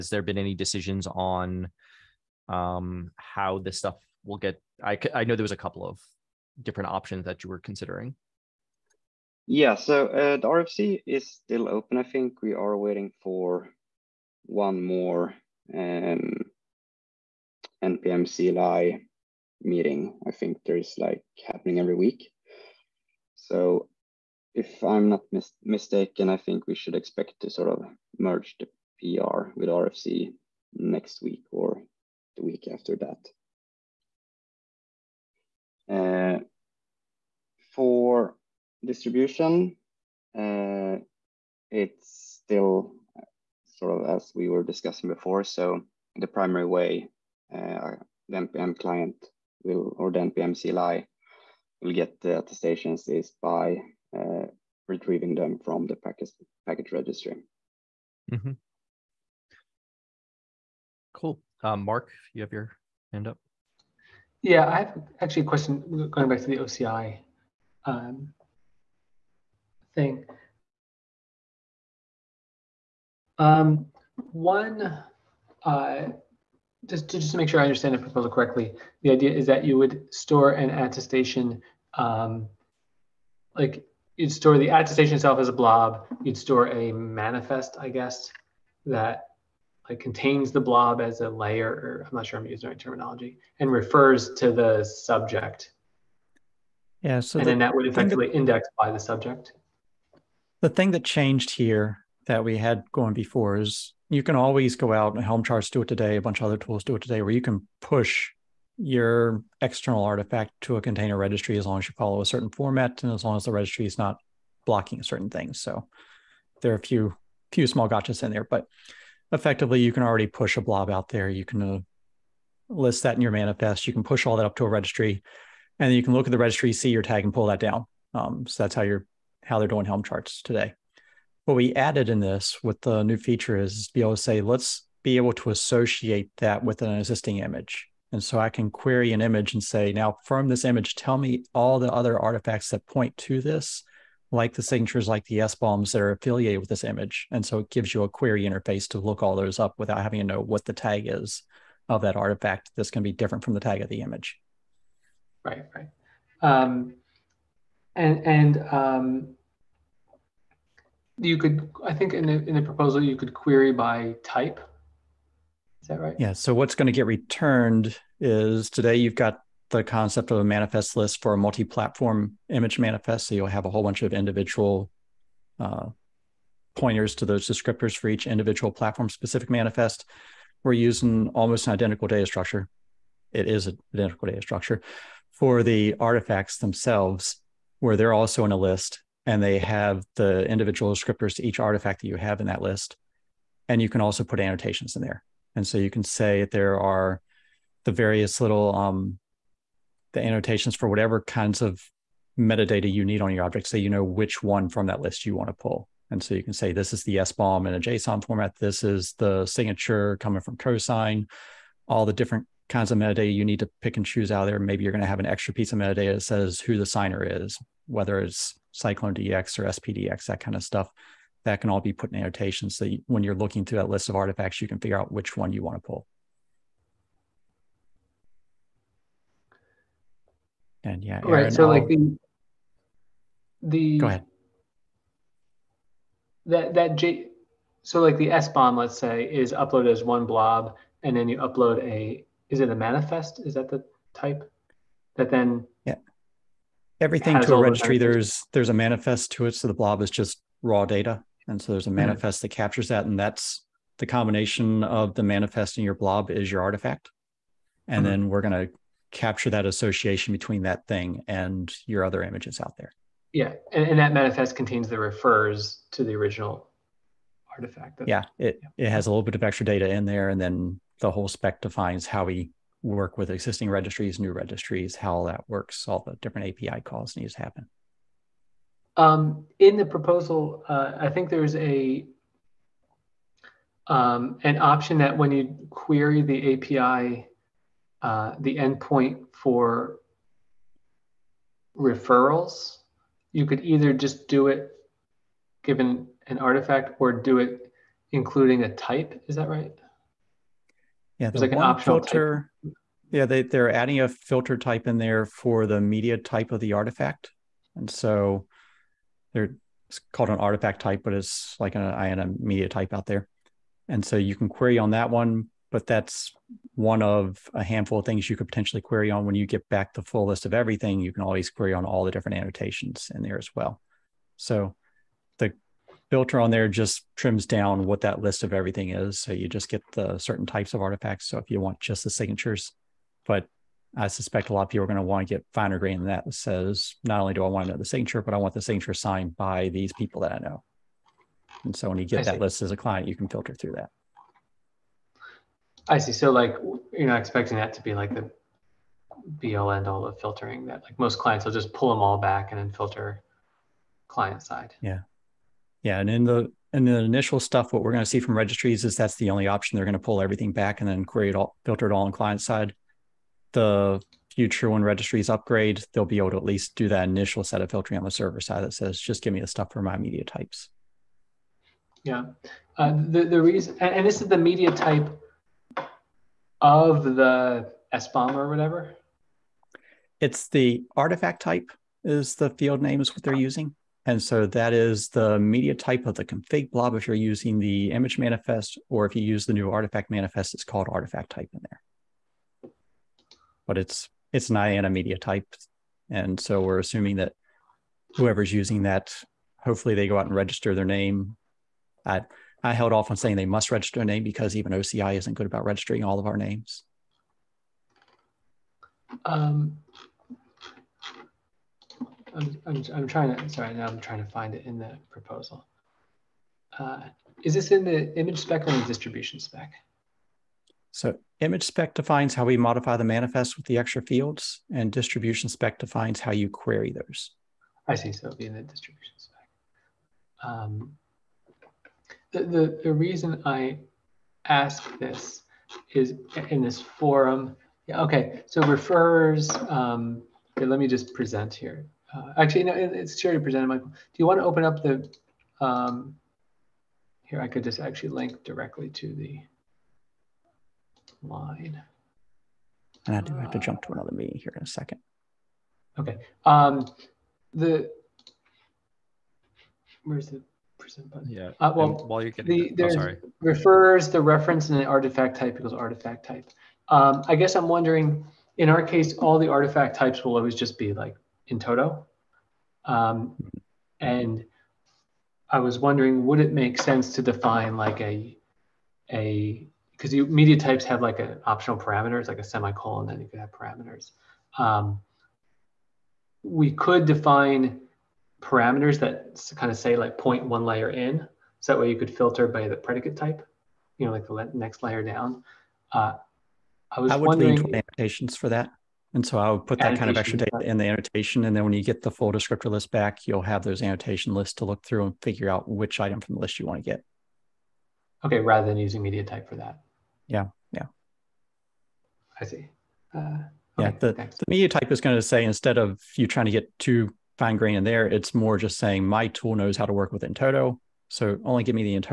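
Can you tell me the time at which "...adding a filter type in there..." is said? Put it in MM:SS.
05:03.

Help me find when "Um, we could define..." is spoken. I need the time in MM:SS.
08:04.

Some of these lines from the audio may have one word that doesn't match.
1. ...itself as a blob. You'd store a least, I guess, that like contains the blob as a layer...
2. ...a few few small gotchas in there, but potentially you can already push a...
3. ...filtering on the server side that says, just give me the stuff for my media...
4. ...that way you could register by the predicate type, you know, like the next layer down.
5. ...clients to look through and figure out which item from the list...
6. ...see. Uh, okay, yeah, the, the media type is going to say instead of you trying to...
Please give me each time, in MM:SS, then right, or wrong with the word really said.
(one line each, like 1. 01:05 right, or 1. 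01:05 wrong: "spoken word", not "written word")
1. 01:25 wrong: "manifest", not "least"
2. 01:56 wrong: "effectively", not "potentially"
3. 06:07 right
4. 08:11 wrong: "filter", not "register"
5. 08:24 wrong: "lists", not "clients"
6. 08:32 right.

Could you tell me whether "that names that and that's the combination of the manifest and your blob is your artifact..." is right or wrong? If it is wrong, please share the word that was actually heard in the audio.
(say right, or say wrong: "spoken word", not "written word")
wrong: "captures", not "names".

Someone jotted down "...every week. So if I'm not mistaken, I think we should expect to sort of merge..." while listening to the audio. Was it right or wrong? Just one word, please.
right.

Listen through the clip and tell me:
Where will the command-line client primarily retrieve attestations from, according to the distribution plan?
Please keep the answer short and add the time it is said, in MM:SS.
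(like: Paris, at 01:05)
package registry, at 00:56.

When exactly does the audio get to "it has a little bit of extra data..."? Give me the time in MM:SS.
04:28.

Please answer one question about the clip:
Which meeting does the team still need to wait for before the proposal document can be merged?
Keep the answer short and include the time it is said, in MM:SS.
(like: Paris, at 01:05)
NPM CLI meeting, at 00:17.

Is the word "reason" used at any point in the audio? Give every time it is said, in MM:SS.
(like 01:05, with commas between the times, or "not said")
06:13, 07:12.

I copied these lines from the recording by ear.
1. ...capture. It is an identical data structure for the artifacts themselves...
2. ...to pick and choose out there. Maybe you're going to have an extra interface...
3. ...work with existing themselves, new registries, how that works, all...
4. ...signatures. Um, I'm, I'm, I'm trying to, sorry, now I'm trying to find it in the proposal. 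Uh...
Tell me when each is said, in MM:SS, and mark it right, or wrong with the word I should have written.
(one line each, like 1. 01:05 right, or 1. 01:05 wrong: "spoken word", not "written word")
1. 03:02 wrong: "structure", not "capture"
2. 03:33 wrong: "piece", not "interface"
3. 04:32 wrong: "registries", not "themselves"
4. 06:46 wrong: "names", not "signatures".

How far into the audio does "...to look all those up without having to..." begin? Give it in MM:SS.
02:28.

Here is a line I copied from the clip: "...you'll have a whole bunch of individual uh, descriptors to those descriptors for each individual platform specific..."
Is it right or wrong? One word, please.
wrong.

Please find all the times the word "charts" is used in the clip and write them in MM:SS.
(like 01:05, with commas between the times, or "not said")
01:45, 02:10.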